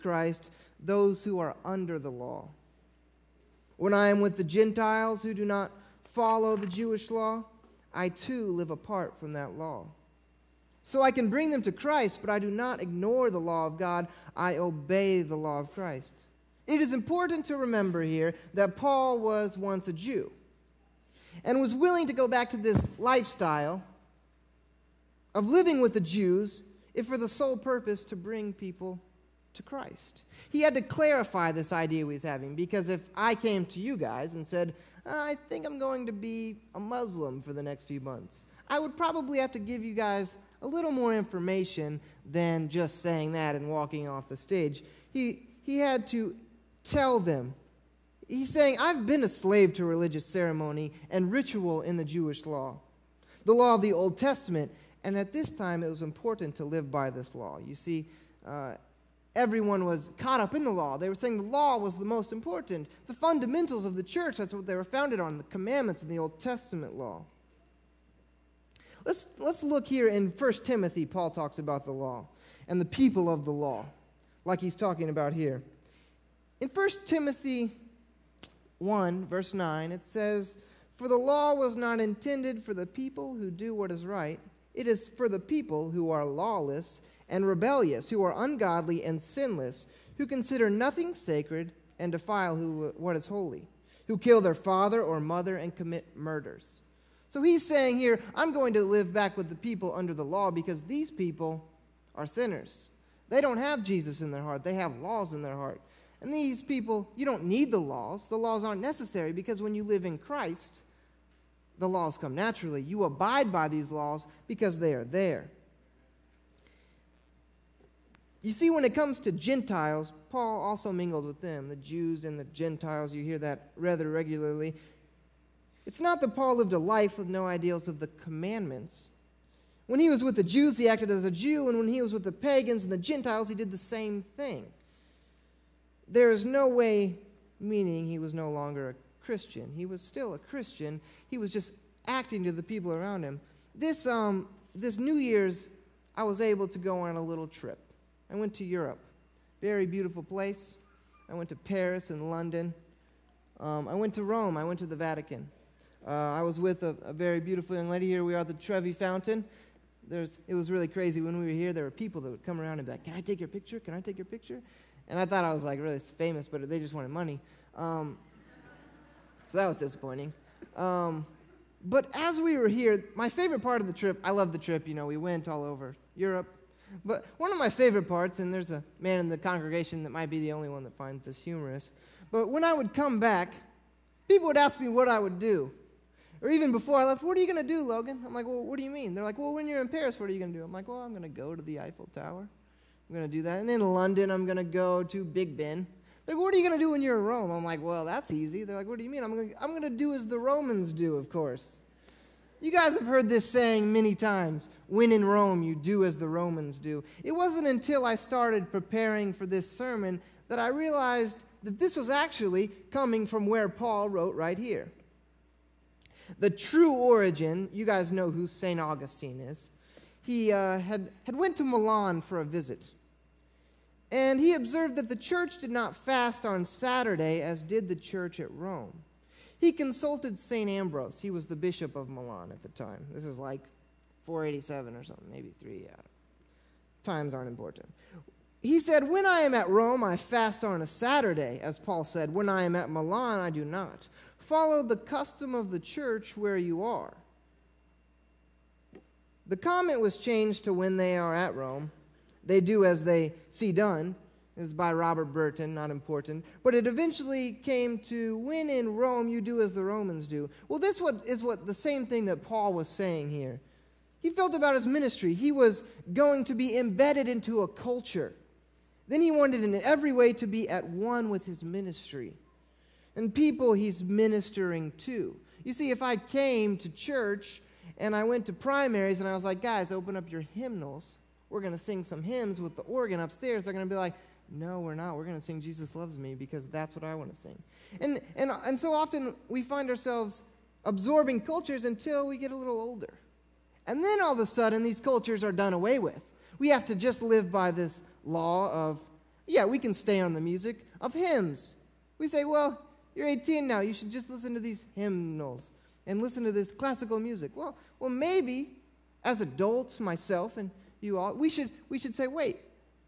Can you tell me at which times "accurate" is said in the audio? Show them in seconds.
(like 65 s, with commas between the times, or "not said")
not said.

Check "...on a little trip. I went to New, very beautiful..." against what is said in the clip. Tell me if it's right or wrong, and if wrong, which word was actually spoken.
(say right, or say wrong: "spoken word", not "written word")
wrong: "Europe", not "New".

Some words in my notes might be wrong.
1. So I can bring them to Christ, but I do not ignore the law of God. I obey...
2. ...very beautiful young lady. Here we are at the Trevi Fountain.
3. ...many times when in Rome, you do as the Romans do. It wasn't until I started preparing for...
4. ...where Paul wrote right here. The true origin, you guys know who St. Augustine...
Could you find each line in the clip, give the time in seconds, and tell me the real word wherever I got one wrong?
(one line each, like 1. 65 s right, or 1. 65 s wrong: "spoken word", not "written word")
1. 10 s right
2. 157 s right
3. 203 s right
4. 213 s right.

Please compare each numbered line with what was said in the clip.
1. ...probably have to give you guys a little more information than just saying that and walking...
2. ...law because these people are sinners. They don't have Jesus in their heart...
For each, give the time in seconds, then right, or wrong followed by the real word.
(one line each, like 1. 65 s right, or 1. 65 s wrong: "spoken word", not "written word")
1. 38 s right
2. 100 s right.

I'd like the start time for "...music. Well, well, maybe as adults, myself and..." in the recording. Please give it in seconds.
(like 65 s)
307 s.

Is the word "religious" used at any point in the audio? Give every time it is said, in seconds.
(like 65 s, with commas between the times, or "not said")
49 s.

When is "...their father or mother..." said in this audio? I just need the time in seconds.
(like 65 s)
94 s.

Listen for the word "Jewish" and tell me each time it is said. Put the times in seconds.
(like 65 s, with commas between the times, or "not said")
6 s, 52 s.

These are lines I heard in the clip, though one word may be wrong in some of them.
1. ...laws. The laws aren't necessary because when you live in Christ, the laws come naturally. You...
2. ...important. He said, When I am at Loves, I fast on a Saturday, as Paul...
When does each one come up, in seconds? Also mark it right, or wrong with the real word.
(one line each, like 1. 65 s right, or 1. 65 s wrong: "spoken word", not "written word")
1. 107 s right
2. 237 s wrong: "Rome", not "Loves".